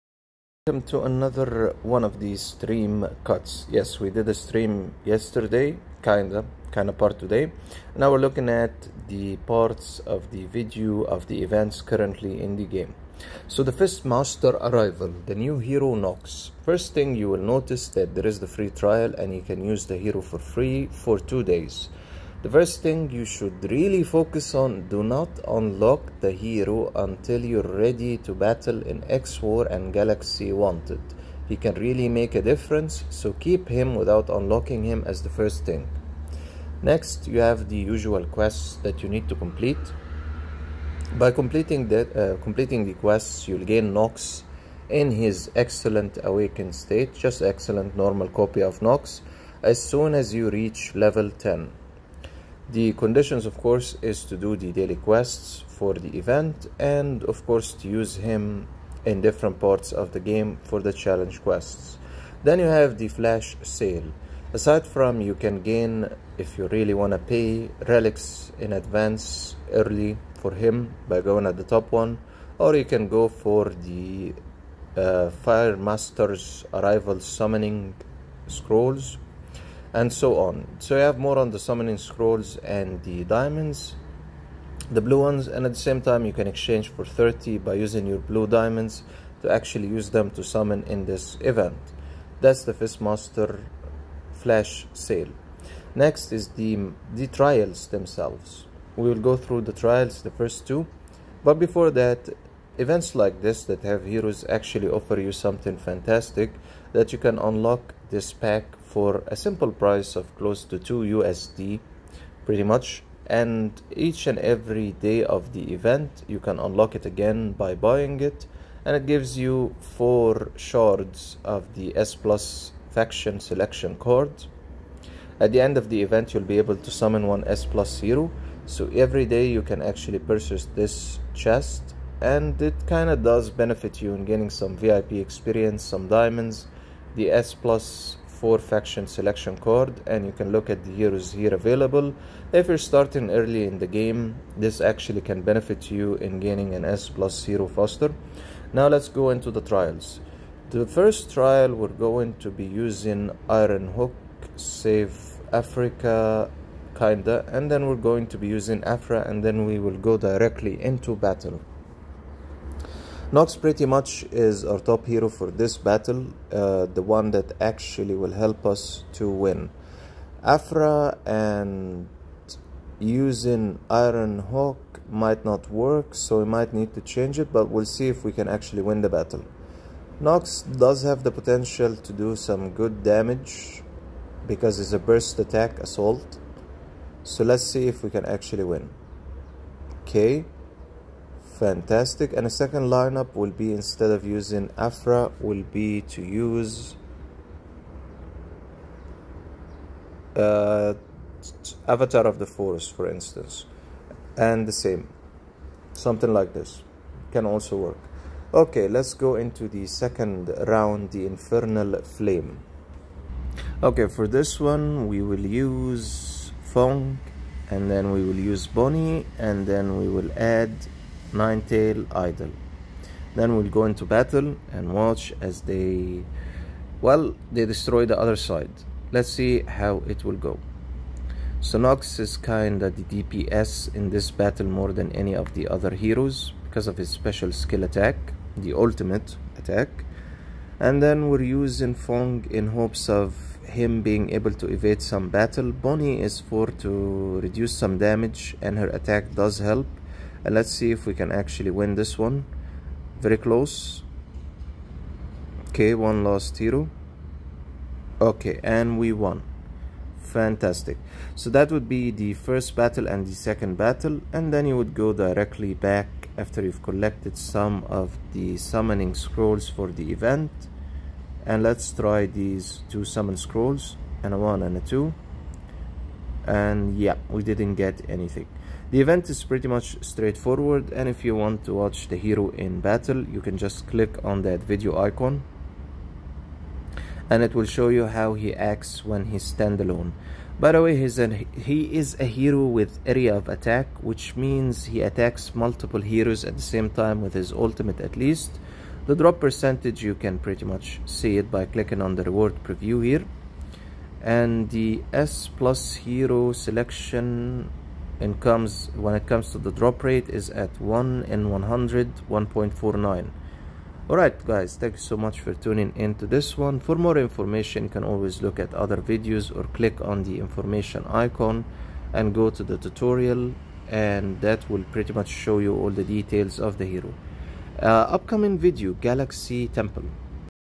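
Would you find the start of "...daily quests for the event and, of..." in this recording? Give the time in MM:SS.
00:54.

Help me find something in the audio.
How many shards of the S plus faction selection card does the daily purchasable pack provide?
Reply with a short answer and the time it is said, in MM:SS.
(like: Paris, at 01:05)
4, at 01:59.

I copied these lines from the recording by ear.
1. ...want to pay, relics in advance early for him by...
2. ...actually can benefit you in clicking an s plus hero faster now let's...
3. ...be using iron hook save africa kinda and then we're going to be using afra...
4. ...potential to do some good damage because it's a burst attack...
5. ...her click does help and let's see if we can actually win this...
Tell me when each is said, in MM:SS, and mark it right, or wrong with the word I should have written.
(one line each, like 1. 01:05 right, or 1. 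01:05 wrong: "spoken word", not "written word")
1. 01:06 right
2. 02:24 wrong: "gaining", not "clicking"
3. 02:32 right
4. 03:01 right
5. 04:08 wrong: "attack", not "click".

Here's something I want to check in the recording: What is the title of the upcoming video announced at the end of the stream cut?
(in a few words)
Galaxy Temple.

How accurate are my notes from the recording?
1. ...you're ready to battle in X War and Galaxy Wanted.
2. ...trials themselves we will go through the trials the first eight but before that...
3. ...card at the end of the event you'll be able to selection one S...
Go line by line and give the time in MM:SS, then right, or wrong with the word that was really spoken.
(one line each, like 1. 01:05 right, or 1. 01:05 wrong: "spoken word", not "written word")
1. 00:27 right
2. 01:37 wrong: "two", not "eight"
3. 02:03 wrong: "summon", not "selection".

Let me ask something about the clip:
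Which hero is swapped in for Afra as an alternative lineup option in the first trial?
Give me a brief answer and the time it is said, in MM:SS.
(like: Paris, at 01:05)
Avatar of the Forest, at 03:21.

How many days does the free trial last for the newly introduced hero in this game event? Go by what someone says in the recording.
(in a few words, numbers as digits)
2.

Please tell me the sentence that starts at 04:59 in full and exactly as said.
The drop percentage, you can pretty much see it by clicking on the reward preview here.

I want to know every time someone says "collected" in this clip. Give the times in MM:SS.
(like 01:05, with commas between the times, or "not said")
04:26.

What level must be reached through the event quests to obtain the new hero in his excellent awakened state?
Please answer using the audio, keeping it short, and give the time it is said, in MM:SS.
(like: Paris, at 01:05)
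10, at 00:50.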